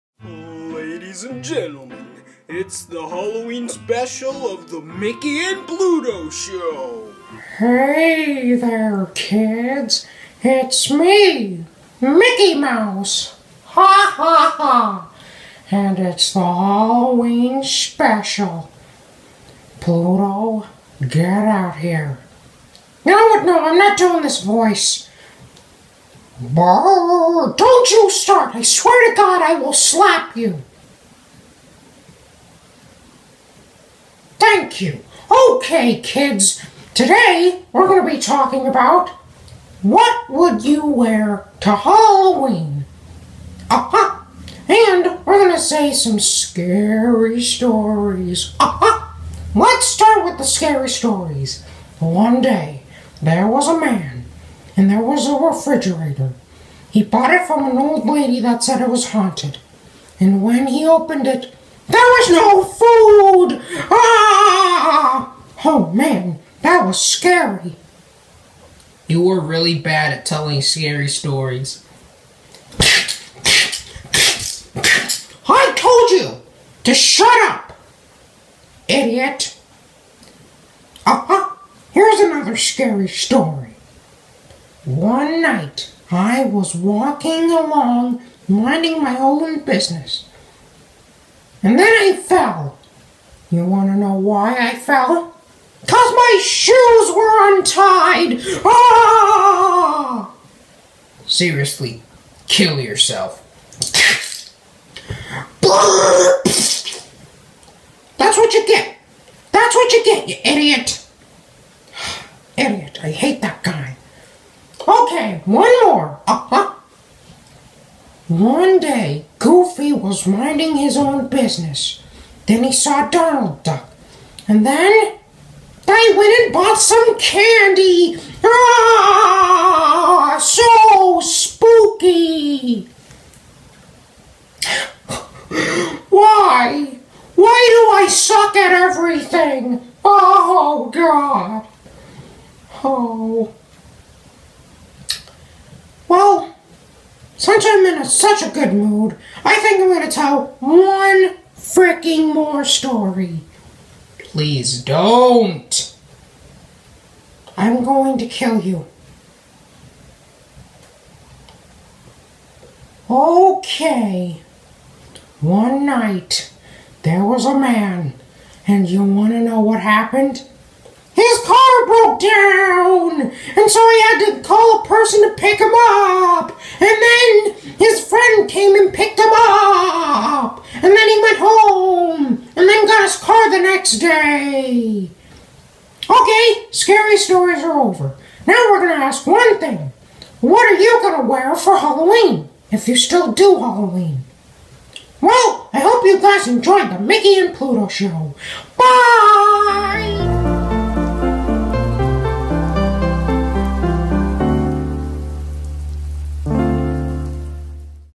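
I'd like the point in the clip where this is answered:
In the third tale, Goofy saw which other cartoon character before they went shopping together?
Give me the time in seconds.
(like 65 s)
123 s.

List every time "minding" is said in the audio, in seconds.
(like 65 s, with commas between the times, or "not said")
88 s, 120 s.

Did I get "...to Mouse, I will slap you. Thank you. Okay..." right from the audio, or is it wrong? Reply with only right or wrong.
wrong.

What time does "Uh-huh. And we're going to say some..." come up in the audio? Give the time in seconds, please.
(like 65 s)
43 s.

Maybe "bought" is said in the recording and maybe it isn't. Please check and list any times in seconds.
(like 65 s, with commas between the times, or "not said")
57 s, 126 s.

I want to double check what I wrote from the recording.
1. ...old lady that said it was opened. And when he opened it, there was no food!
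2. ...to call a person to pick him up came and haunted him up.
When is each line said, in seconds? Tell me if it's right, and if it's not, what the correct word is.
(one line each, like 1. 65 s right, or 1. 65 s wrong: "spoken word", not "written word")
1. 57 s wrong: "haunted", not "opened"
2. 174 s wrong: "picked", not "haunted".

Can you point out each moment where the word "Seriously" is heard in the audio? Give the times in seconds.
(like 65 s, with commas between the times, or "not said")
101 s.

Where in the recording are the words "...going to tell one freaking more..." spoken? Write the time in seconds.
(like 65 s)
149 s.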